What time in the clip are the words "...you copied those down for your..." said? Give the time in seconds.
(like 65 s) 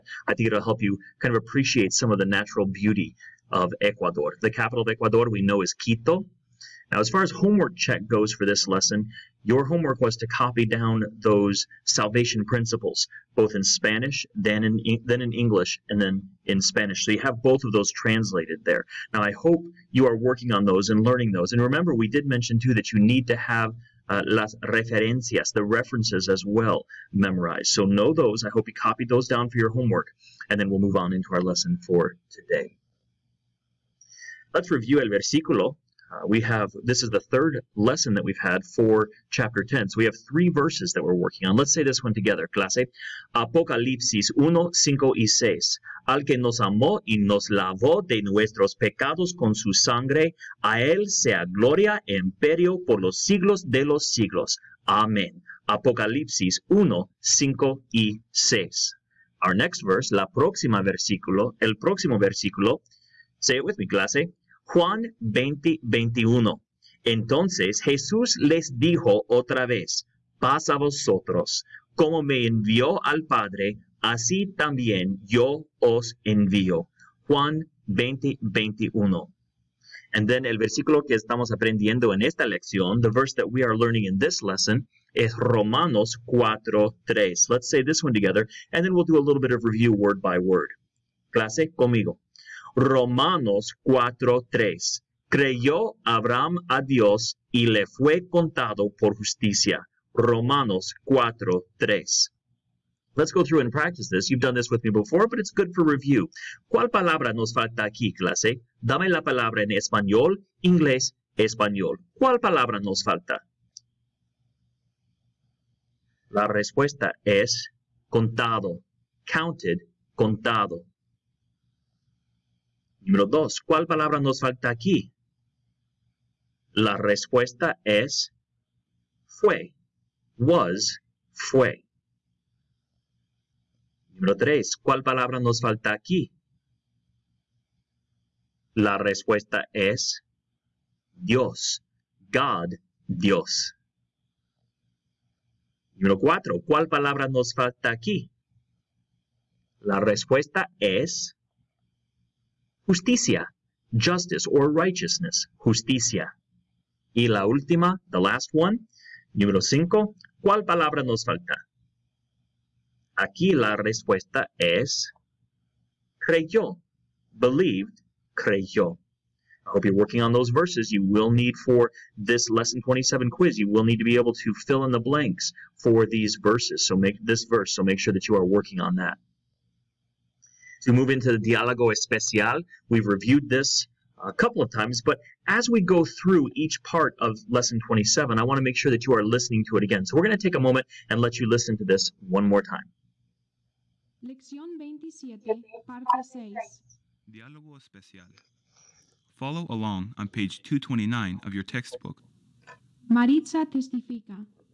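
28 s.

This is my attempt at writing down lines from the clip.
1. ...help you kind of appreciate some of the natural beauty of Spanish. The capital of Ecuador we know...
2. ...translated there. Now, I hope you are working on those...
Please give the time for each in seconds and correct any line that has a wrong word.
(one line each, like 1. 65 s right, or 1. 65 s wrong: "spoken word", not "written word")
1. 0 s wrong: "Ecuador", not "Spanish"
2. 17 s right.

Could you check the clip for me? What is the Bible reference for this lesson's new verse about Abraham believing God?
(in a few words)
Romanos 4:3.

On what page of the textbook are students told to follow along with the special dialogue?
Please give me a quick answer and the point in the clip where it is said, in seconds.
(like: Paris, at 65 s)
229, at 200 s.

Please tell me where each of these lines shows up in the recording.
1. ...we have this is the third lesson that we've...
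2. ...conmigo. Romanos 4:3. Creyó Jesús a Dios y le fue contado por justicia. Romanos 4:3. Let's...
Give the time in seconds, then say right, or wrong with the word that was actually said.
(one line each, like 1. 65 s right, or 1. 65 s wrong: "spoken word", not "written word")
1. 36 s right
2. 91 s wrong: "Abraham", not "Jesús".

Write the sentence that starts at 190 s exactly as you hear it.
So we're going to take a moment and let you listen to this one more time.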